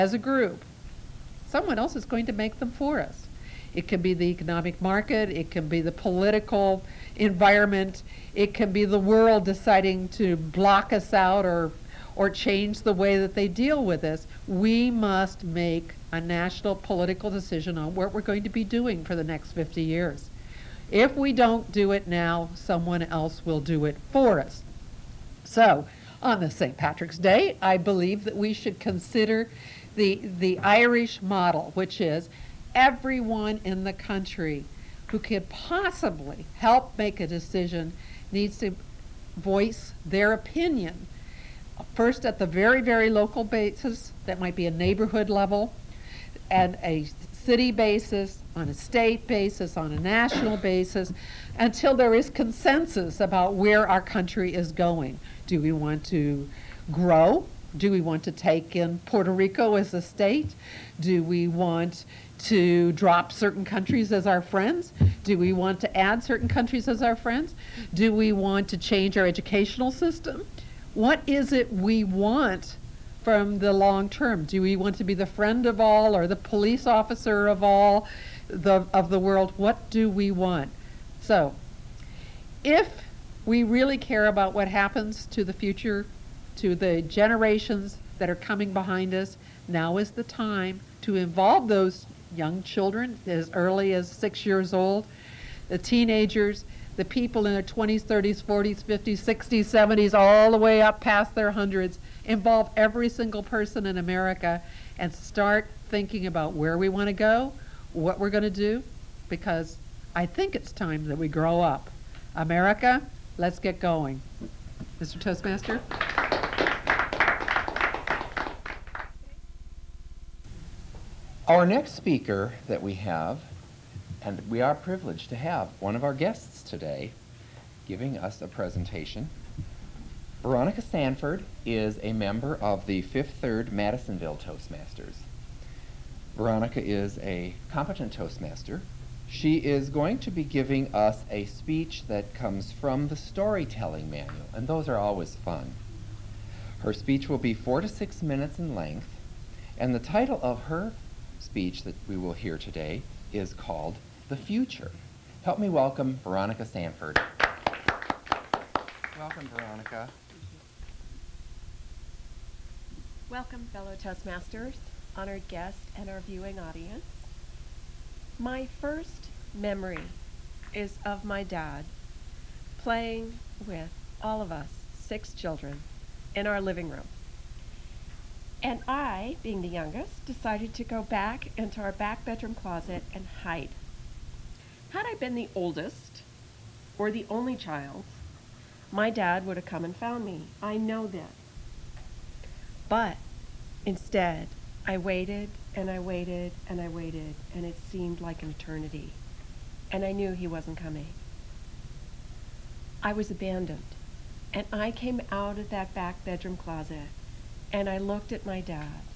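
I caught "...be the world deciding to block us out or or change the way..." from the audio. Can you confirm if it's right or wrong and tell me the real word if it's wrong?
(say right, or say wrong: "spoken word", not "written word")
right.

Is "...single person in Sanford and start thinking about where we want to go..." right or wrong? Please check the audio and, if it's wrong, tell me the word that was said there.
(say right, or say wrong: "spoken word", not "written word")
wrong: "America", not "Sanford".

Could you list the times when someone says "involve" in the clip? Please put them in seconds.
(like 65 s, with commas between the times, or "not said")
91 s, 102 s.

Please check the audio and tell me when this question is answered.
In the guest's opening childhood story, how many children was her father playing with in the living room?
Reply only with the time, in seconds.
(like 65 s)
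174 s.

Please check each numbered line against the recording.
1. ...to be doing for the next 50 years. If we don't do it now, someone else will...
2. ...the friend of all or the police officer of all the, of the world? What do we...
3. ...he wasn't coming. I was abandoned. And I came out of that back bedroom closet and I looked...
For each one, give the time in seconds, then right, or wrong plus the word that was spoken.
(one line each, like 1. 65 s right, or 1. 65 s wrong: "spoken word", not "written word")
1. 18 s right
2. 75 s right
3. 200 s right.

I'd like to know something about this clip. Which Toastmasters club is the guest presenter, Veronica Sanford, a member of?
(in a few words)
Fifth Third Madisonville Toastmasters.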